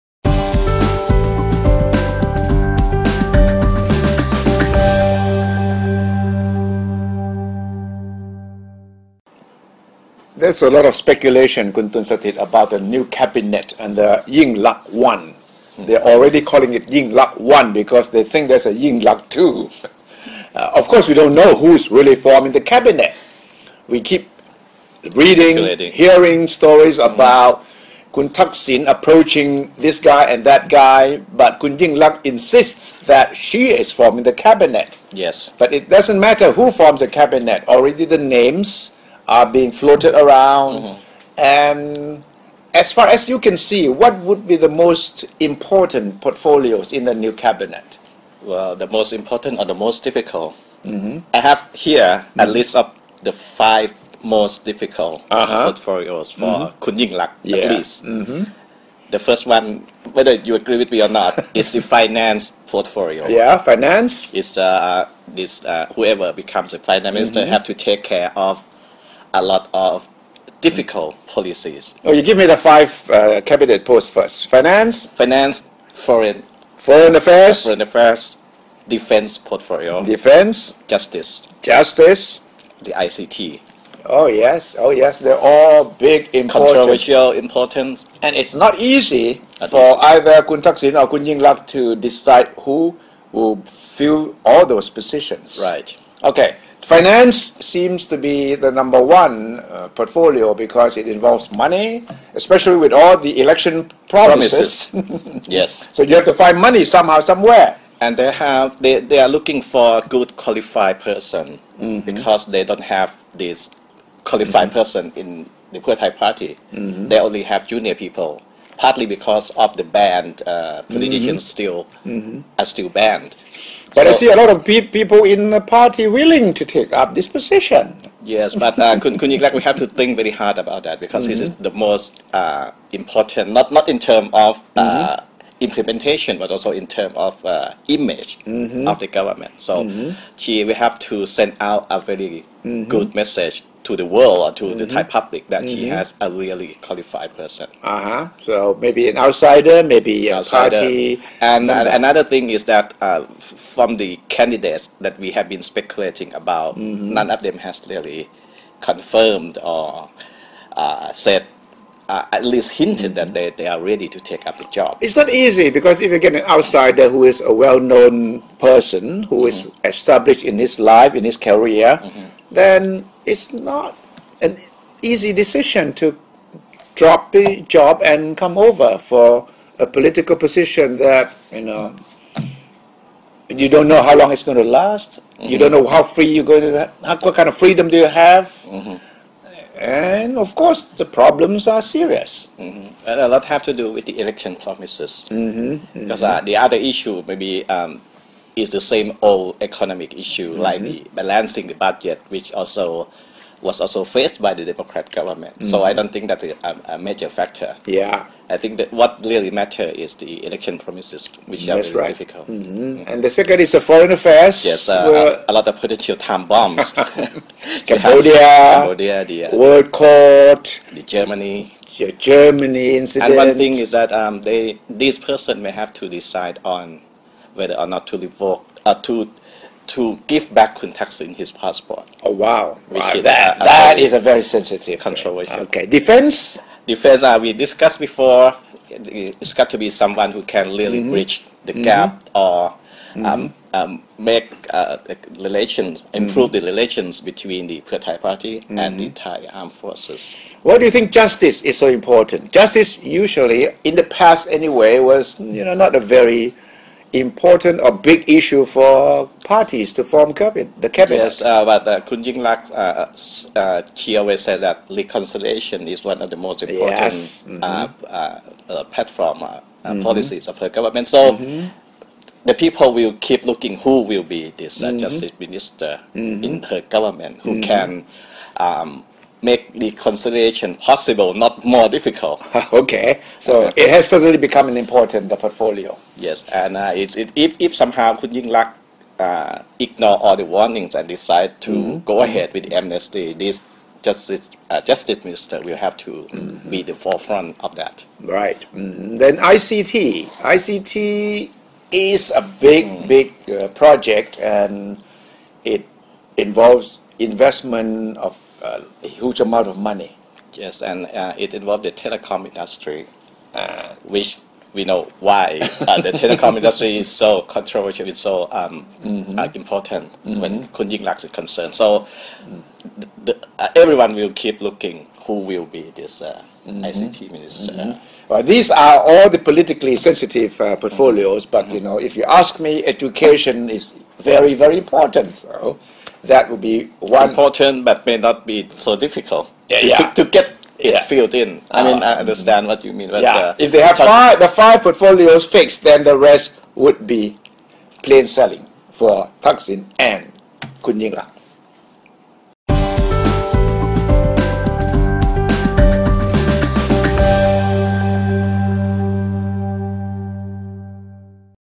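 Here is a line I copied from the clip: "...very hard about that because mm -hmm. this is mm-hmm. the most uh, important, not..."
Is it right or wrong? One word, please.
right.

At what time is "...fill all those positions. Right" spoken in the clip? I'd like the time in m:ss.
1:33.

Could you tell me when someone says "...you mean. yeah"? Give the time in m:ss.
5:42.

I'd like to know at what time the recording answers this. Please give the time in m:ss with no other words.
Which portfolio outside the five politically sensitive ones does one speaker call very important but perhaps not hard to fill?
5:32.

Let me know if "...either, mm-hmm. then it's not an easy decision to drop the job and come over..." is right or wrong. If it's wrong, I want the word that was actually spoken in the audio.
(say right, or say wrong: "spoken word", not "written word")
wrong: "career", not "either".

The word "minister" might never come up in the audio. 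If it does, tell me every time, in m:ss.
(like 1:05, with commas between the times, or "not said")
1:07, 4:35, 4:55, 5:27.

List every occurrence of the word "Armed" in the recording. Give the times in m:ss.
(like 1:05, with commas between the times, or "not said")
4:09.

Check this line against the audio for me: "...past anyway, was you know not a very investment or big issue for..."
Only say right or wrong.
wrong.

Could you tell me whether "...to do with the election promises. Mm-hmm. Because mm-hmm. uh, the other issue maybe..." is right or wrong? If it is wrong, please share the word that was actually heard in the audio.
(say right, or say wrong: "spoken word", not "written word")
right.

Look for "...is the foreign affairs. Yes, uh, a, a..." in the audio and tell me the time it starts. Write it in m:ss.
3:33.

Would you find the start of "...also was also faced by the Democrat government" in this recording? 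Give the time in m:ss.
3:22.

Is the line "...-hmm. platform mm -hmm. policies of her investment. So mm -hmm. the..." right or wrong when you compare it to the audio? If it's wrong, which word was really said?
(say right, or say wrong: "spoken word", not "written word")
wrong: "government", not "investment".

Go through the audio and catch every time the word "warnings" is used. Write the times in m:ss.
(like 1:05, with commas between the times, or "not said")
4:50.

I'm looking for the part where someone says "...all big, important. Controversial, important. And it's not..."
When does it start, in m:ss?
1:25.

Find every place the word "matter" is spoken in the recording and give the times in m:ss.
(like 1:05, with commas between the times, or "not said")
0:36, 3:29.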